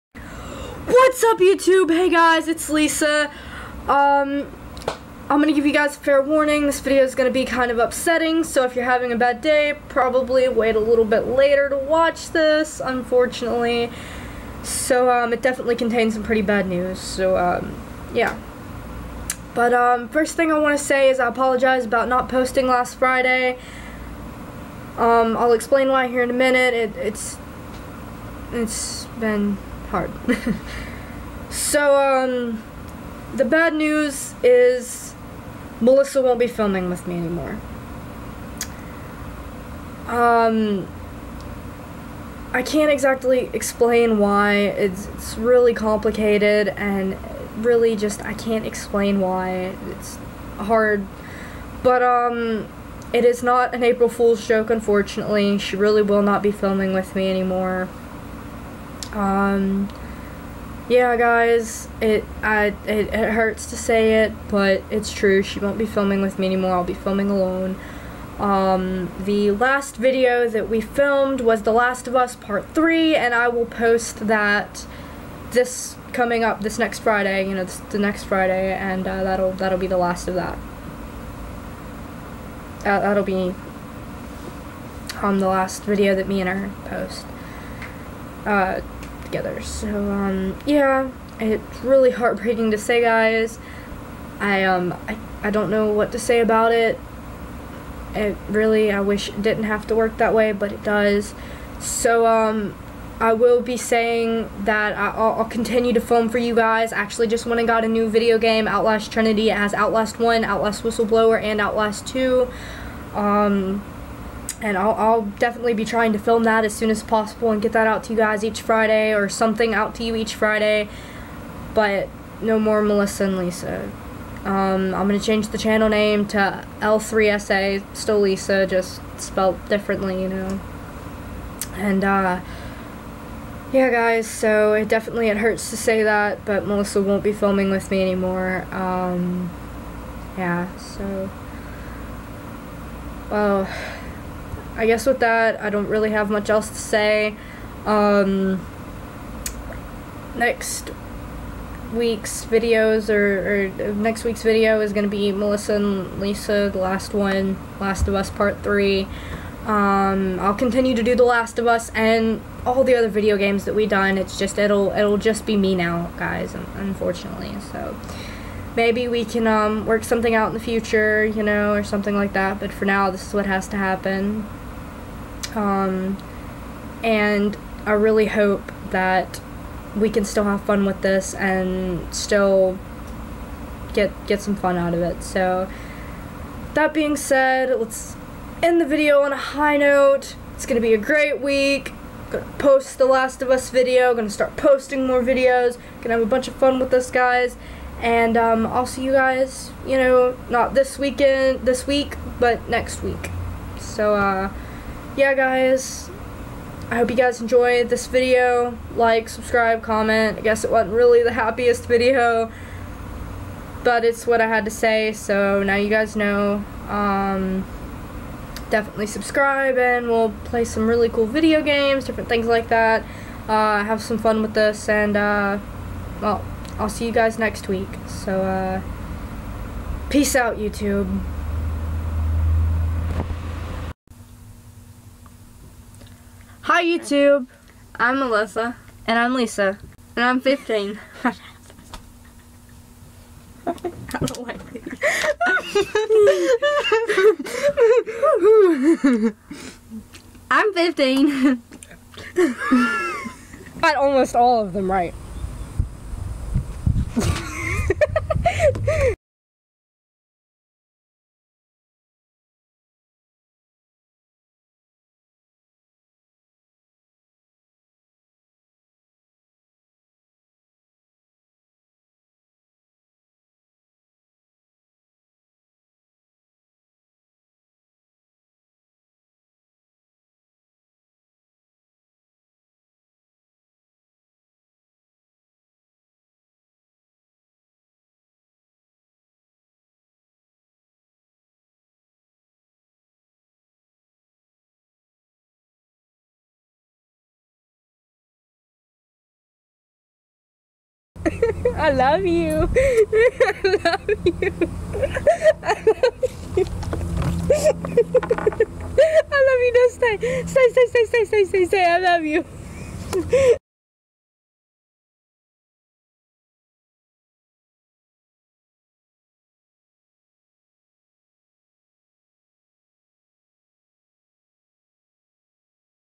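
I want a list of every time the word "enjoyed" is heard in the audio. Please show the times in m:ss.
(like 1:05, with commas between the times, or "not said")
3:27.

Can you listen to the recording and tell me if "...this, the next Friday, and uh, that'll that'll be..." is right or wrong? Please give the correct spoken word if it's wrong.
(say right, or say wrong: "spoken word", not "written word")
right.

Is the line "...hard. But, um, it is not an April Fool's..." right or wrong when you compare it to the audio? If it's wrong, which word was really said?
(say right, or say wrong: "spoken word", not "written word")
right.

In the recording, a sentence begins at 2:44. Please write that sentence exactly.
It's just it'll it'll just be me now, guys, unfortunately.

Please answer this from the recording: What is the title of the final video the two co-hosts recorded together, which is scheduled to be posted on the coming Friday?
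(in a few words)
The Last of Us Part 3.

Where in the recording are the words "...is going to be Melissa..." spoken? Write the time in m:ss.
2:34.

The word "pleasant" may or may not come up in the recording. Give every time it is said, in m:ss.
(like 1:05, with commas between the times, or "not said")
not said.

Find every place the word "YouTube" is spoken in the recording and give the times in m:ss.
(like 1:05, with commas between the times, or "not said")
0:01, 3:50, 3:56.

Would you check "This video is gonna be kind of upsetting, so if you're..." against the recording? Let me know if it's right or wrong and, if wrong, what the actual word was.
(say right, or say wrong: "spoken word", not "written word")
right.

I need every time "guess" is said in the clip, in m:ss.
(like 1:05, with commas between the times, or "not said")
2:24, 3:30.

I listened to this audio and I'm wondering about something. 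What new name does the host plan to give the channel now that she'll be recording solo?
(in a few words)
L3SA.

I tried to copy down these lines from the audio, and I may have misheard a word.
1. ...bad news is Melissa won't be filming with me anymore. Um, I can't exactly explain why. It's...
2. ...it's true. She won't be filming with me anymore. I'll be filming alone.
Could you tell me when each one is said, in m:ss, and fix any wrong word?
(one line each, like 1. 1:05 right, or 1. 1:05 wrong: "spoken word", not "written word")
1. 0:33 right
2. 1:04 right.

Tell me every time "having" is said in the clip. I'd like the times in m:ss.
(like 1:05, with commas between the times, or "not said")
0:08.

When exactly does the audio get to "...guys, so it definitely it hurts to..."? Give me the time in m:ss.
2:13.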